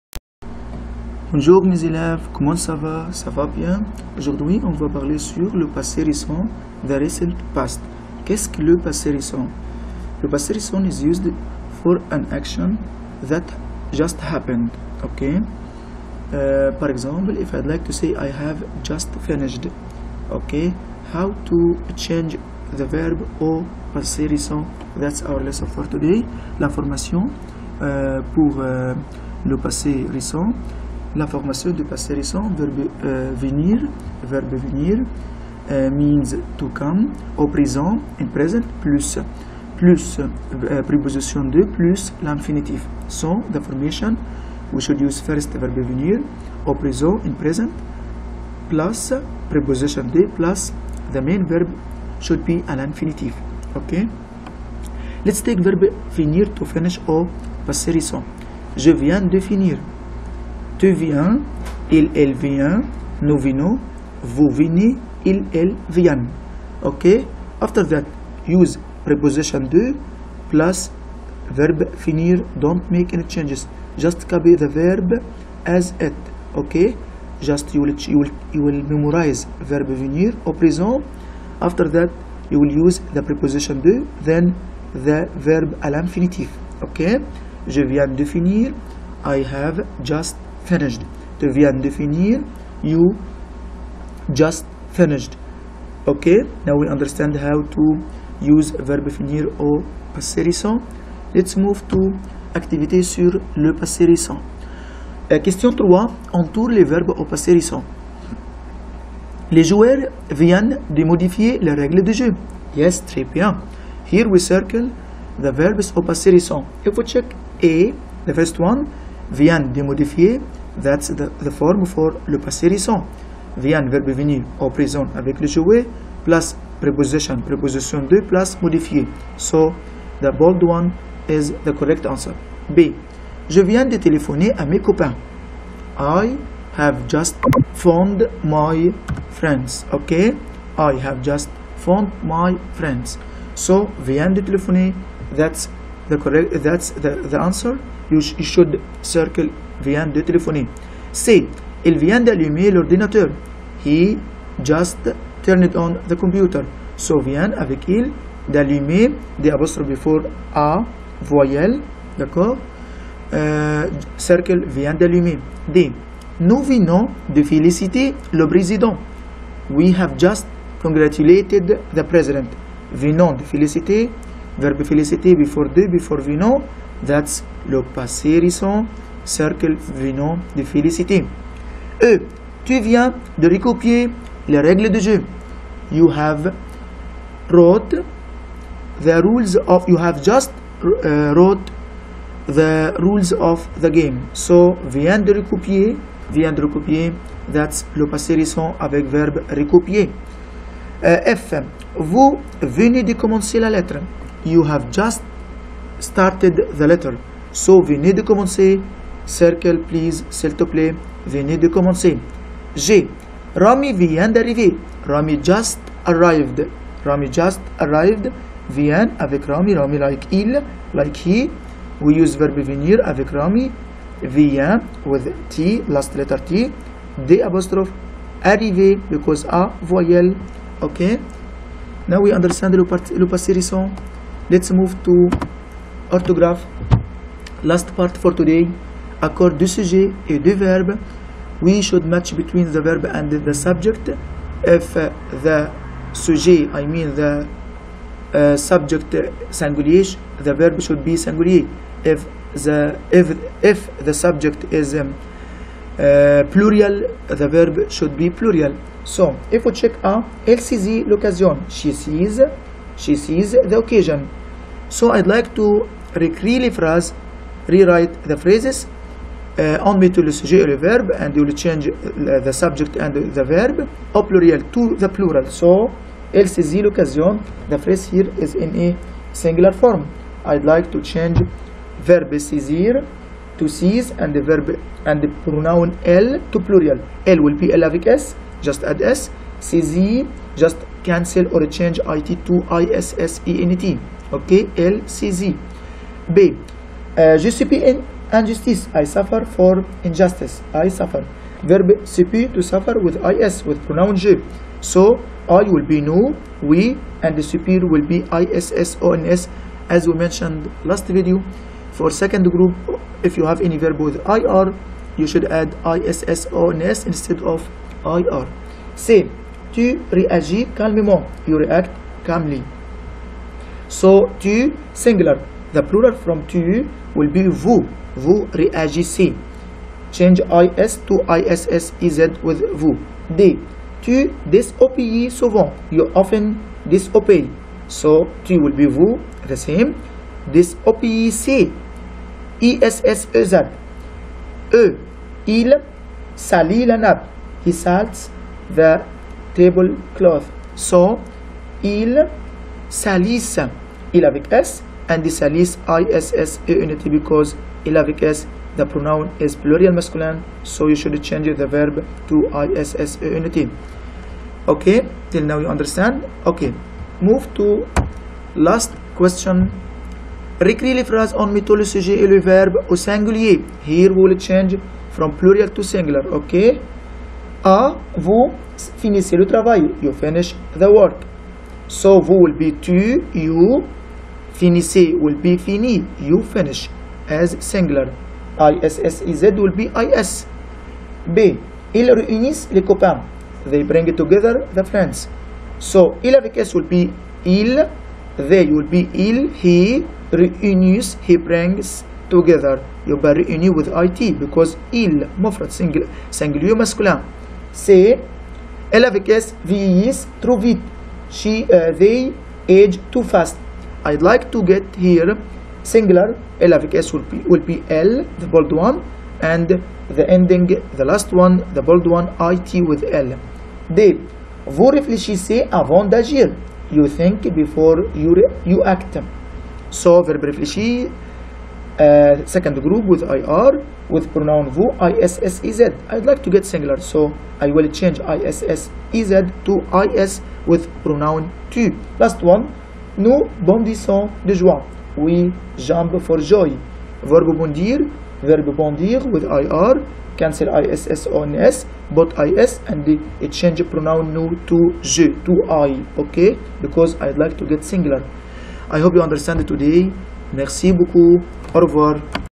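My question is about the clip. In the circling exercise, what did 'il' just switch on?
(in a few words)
l'ordinateur.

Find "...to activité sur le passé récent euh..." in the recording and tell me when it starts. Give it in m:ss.
1:41.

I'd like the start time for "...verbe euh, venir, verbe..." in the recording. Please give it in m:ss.
0:32.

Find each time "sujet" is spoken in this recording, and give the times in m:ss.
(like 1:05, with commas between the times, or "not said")
3:59, 4:06, 4:30, 6:11.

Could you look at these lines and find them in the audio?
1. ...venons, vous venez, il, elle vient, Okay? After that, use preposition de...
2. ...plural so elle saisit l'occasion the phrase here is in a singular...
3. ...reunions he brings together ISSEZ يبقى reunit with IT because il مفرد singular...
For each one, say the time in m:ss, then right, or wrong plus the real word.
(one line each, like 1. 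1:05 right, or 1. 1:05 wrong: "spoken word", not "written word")
1. 1:03 right
2. 4:35 right
3. 6:40 wrong: "You", not "ISSEZ".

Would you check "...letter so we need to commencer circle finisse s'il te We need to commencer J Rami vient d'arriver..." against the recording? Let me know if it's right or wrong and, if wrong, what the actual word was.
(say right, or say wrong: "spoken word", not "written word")
wrong: "please", not "finisse".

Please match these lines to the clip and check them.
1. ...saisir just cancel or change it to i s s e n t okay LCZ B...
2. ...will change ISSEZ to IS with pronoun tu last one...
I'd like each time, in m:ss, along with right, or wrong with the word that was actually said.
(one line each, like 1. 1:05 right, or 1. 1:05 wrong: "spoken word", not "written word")
1. 4:49 right
2. 7:17 right.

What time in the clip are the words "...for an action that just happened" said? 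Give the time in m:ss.
0:11.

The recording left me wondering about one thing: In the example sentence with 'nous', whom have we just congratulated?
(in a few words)
le président.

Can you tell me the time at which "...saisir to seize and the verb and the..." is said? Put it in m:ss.
4:42.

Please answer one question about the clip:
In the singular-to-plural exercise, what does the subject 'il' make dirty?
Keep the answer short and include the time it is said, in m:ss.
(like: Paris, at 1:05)
la nappe, at 5:46.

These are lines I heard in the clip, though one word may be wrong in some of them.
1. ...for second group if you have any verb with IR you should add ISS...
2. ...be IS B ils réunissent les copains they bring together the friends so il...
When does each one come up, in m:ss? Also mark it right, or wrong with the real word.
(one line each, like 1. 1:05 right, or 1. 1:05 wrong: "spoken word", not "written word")
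1. 5:11 right
2. 6:29 right.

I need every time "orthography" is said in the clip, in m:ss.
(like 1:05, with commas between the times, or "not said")
3:56.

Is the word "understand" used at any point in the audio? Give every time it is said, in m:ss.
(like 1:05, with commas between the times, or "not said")
1:36, 3:52, 6:05, 7:39.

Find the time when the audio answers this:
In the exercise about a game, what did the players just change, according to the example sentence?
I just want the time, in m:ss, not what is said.
1:51.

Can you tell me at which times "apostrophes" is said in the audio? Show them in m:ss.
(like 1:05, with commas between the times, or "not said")
2:39, 3:47.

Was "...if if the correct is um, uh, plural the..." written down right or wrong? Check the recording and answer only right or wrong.
wrong.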